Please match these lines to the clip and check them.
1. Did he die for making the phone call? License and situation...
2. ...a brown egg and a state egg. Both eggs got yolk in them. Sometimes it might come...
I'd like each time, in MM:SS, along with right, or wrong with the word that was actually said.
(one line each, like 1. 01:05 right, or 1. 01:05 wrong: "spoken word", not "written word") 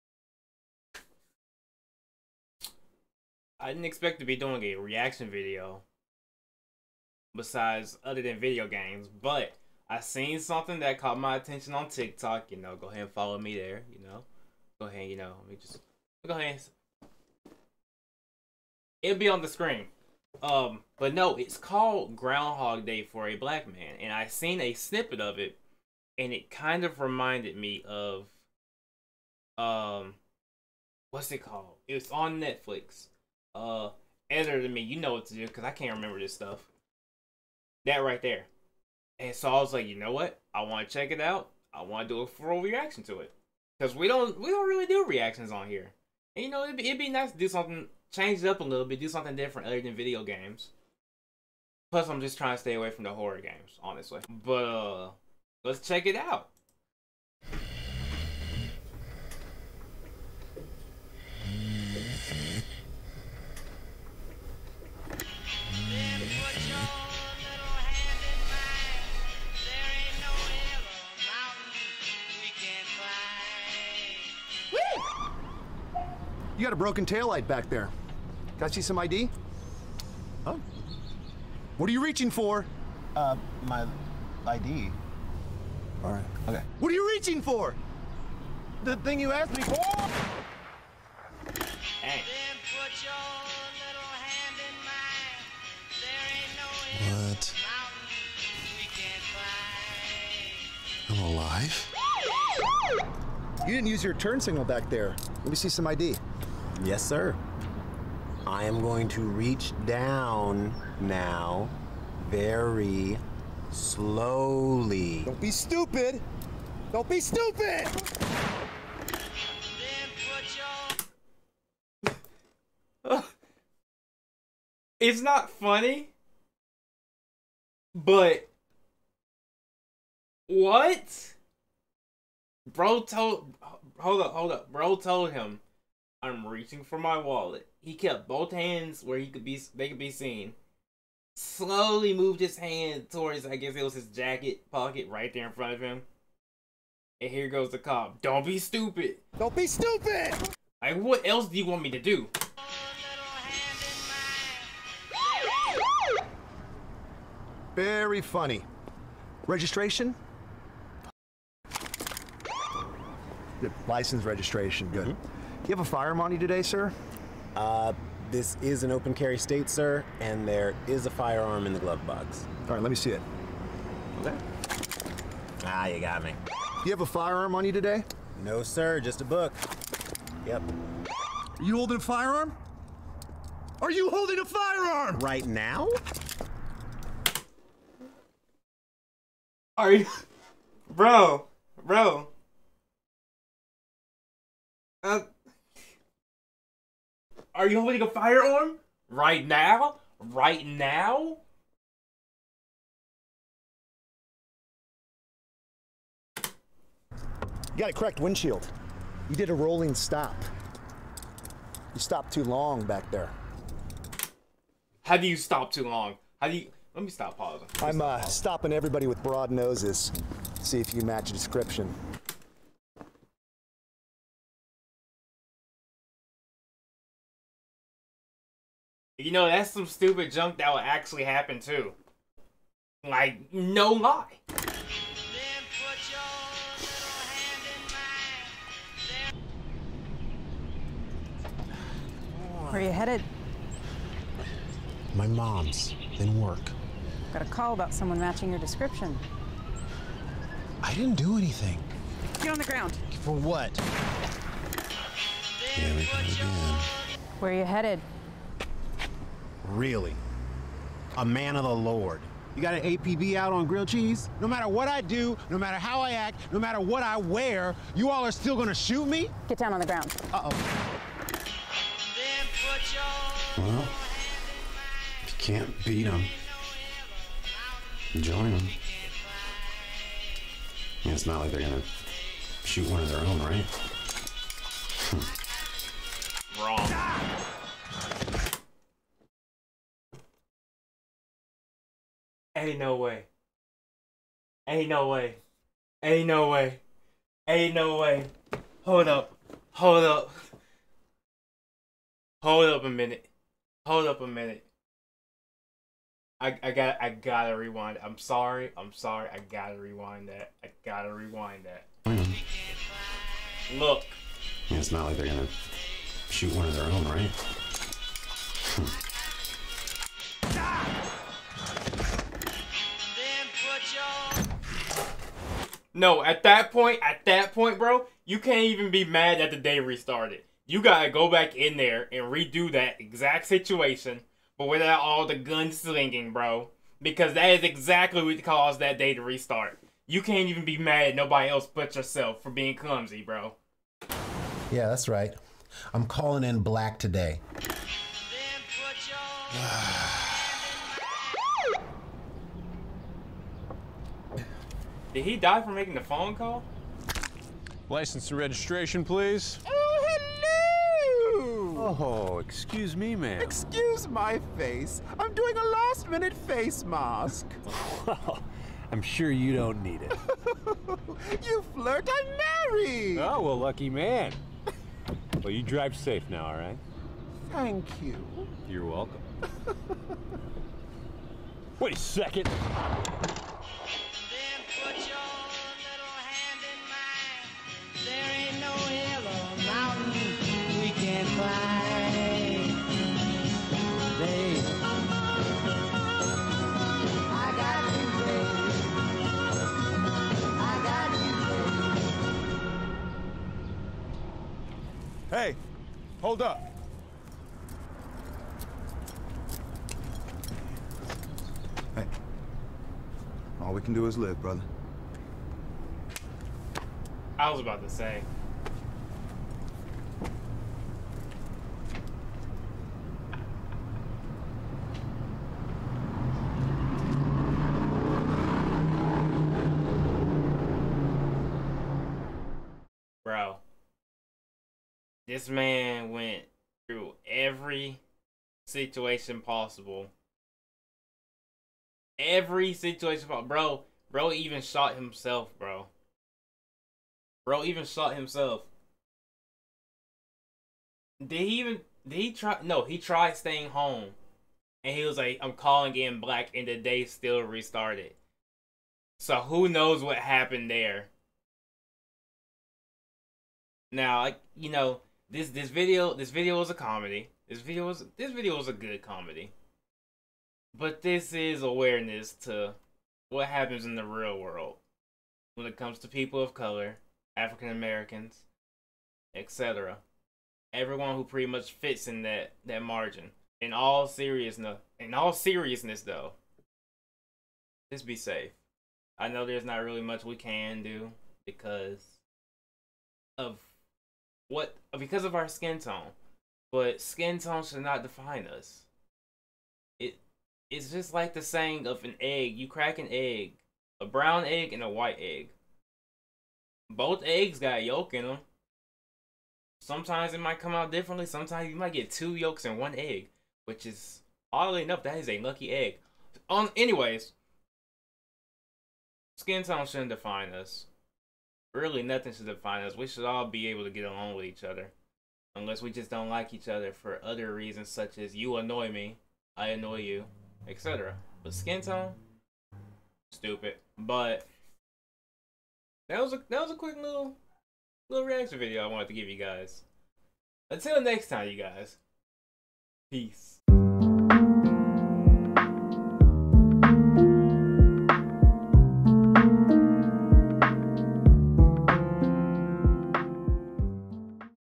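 1. 05:55 wrong: "registration", not "situation"
2. 08:24 wrong: "white", not "state".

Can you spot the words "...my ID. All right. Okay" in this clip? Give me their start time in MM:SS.
01:23.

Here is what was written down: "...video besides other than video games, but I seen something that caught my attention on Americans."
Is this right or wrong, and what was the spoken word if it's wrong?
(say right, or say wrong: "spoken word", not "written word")
wrong: "TikTok", not "Americans".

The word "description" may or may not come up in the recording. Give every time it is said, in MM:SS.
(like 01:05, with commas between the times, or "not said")
03:41, 04:08.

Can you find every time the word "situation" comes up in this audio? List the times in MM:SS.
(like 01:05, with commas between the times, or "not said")
05:33, 07:18, 07:22.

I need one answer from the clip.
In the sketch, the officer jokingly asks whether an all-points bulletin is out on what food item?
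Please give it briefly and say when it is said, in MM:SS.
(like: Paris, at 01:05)
grilled cheese, at 04:23.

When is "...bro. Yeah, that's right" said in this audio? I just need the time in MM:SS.
05:43.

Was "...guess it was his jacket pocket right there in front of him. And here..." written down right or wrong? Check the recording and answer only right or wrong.
right.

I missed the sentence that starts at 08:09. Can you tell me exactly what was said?
I know there's not really much we can do because of what because of our skin tone.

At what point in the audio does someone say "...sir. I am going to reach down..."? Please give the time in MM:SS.
01:47.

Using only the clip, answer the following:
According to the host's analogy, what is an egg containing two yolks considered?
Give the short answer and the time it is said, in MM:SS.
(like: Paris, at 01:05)
lucky egg, at 08:35.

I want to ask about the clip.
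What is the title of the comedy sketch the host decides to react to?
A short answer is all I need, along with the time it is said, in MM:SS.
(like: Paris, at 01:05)
Groundhog Day for a Black Man, at 00:22.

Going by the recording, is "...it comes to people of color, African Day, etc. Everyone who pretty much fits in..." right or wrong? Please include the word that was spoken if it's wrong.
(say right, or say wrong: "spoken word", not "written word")
wrong: "Americans", not "Day".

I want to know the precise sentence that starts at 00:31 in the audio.
It's on Netflix uh editor than me.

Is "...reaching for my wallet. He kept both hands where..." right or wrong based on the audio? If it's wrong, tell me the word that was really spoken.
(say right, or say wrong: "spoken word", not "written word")
right.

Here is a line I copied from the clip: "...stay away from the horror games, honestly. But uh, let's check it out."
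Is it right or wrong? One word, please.
right.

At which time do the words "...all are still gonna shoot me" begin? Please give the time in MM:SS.
04:28.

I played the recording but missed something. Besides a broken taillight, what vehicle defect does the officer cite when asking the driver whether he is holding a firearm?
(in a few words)
cracked windshield.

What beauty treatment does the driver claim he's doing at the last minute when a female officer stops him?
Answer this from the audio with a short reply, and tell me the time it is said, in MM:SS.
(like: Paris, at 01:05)
face mask, at 06:06.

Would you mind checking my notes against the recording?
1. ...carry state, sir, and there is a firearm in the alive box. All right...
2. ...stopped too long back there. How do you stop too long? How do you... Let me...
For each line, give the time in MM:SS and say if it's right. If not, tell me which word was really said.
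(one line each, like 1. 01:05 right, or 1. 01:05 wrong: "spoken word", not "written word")
1. 02:49 wrong: "glove", not "alive"
2. 03:31 right.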